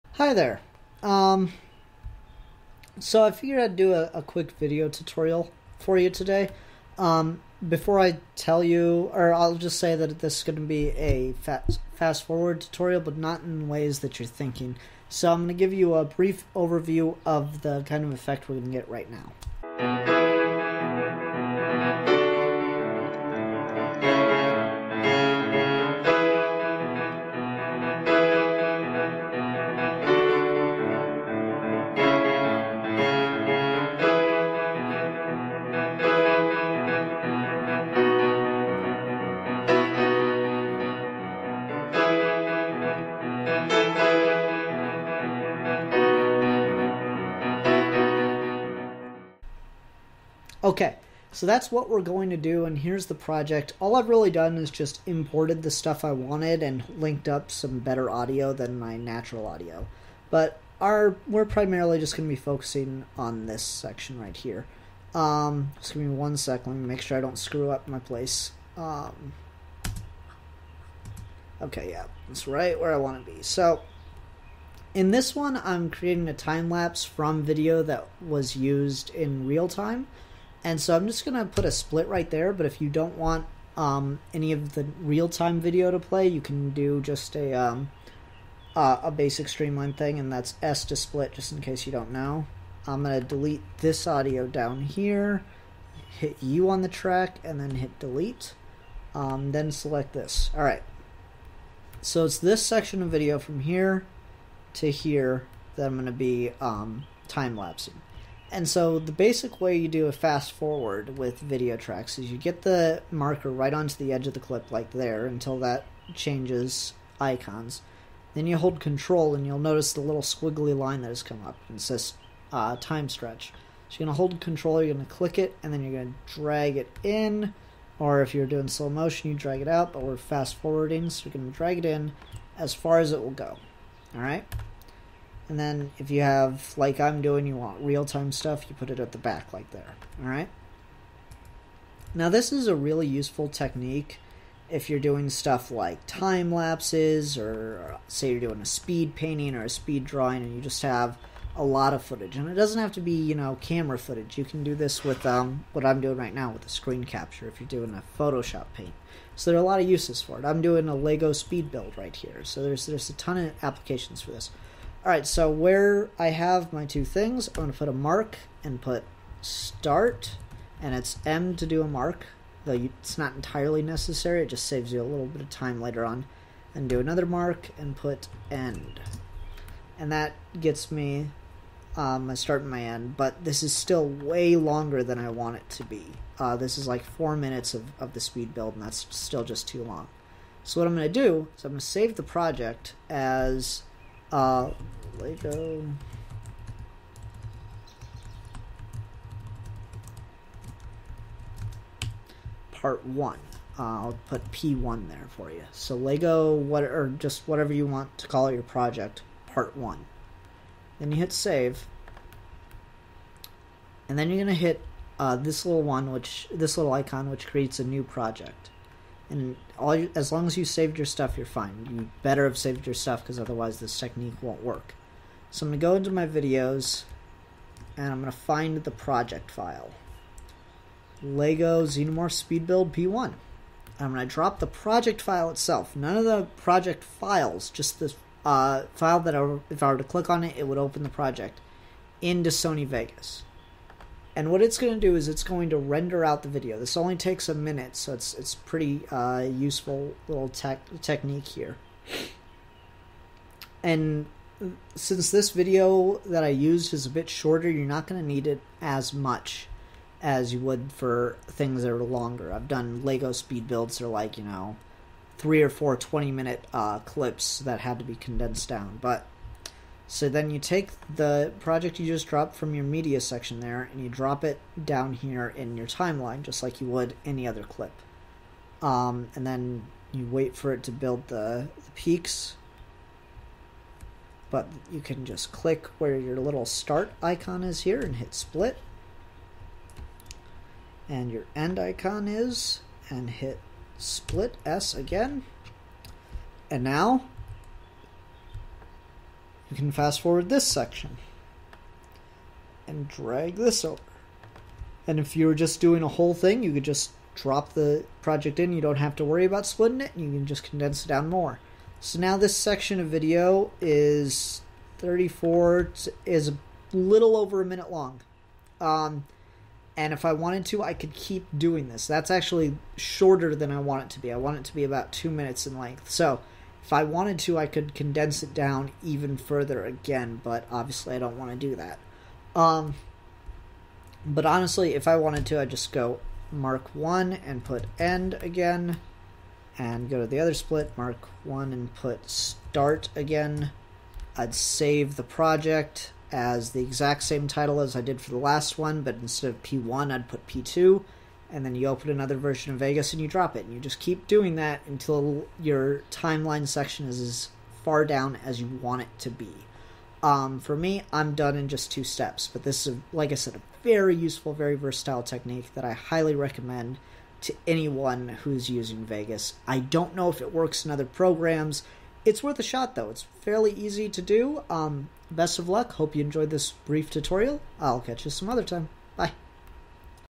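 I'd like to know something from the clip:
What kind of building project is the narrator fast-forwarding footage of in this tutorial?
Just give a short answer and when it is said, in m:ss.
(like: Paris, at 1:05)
Lego speed build, at 2:40.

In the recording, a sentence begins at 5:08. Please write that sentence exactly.
You don't have to worry about splitting it.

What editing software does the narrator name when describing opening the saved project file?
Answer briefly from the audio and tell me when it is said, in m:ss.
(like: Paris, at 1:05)
Sony Vegas, at 4:02.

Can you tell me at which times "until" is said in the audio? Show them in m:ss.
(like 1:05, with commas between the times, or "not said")
1:55, 5:54.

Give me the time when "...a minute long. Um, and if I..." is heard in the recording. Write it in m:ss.
5:17.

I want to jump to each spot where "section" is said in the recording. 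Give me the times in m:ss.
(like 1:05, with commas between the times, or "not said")
1:03, 1:42, 4:33, 5:00, 5:12, 5:56.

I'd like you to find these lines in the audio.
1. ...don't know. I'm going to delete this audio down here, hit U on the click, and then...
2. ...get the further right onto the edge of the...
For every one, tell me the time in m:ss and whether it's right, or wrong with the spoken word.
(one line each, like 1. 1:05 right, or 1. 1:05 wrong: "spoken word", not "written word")
1. 1:31 wrong: "track", not "click"
2. 1:52 wrong: "marker", not "further".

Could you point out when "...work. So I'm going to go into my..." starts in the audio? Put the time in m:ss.
3:44.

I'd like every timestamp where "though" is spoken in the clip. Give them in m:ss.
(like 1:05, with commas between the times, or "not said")
2:52, 6:12.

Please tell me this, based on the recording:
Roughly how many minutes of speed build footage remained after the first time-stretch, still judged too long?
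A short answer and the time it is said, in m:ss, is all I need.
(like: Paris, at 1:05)
4 minutes, at 3:07.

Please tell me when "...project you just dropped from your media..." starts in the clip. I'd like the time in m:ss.
4:31.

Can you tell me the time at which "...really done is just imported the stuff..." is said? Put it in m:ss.
0:54.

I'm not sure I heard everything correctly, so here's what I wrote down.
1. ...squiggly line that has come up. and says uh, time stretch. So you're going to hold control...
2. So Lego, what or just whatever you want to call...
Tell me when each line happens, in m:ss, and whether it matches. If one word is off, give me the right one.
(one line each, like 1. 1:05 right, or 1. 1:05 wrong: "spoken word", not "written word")
1. 2:00 right
2. 3:25 right.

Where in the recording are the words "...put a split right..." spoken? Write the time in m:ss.
1:21.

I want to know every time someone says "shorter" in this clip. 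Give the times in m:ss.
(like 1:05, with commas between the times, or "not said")
4:17, 5:22.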